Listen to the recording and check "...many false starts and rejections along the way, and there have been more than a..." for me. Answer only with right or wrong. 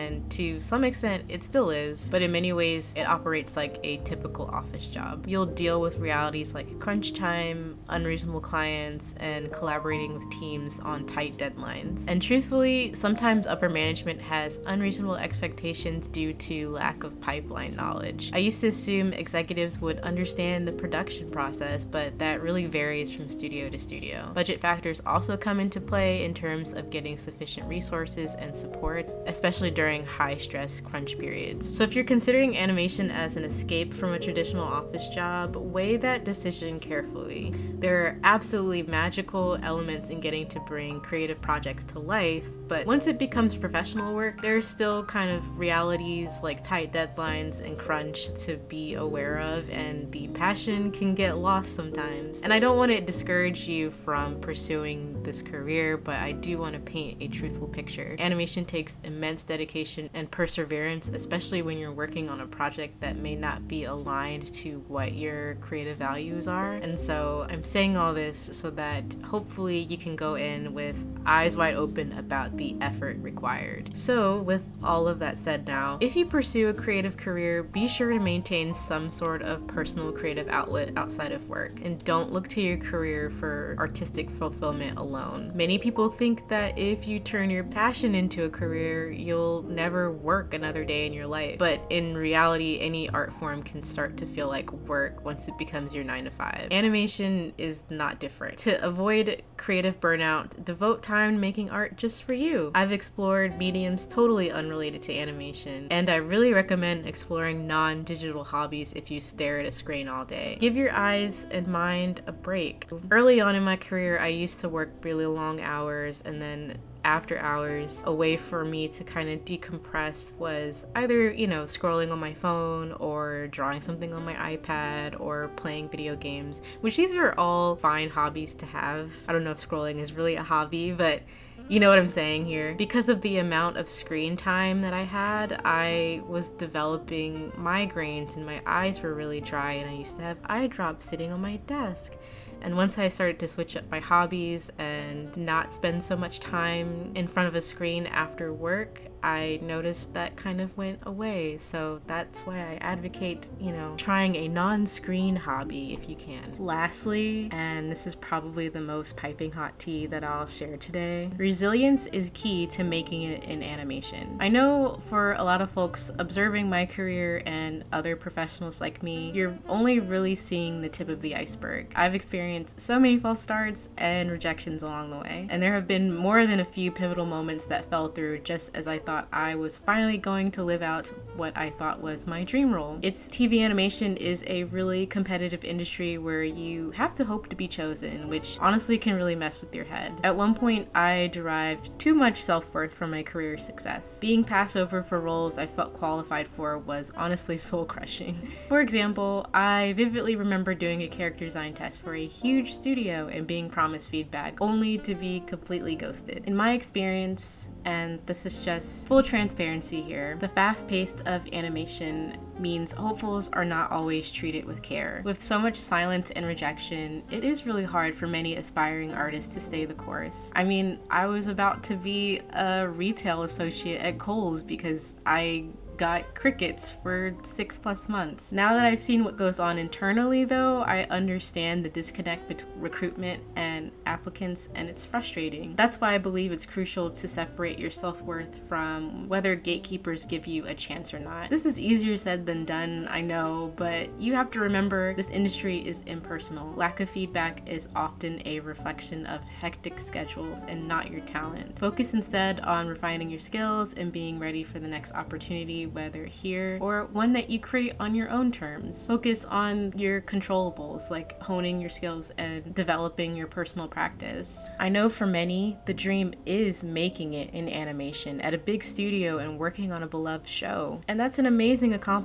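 right.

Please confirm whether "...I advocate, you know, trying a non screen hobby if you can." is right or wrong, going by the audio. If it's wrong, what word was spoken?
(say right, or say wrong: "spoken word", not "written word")
right.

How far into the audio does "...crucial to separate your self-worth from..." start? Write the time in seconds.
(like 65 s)
236 s.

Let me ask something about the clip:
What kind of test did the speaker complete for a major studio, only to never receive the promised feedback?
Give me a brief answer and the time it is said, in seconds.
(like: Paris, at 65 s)
character design test, at 201 s.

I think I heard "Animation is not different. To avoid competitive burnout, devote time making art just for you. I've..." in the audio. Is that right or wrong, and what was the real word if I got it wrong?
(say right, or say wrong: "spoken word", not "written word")
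wrong: "creative", not "competitive".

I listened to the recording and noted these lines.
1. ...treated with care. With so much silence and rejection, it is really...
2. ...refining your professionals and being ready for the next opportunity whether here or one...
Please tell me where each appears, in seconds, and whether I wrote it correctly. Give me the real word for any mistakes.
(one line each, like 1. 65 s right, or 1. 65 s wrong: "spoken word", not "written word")
1. 214 s right
2. 252 s wrong: "skills", not "professionals".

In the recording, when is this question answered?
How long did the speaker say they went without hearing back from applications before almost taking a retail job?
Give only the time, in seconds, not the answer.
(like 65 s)
227 s.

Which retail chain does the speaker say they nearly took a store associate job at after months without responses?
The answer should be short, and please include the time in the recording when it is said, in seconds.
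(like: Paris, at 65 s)
Kohl's, at 224 s.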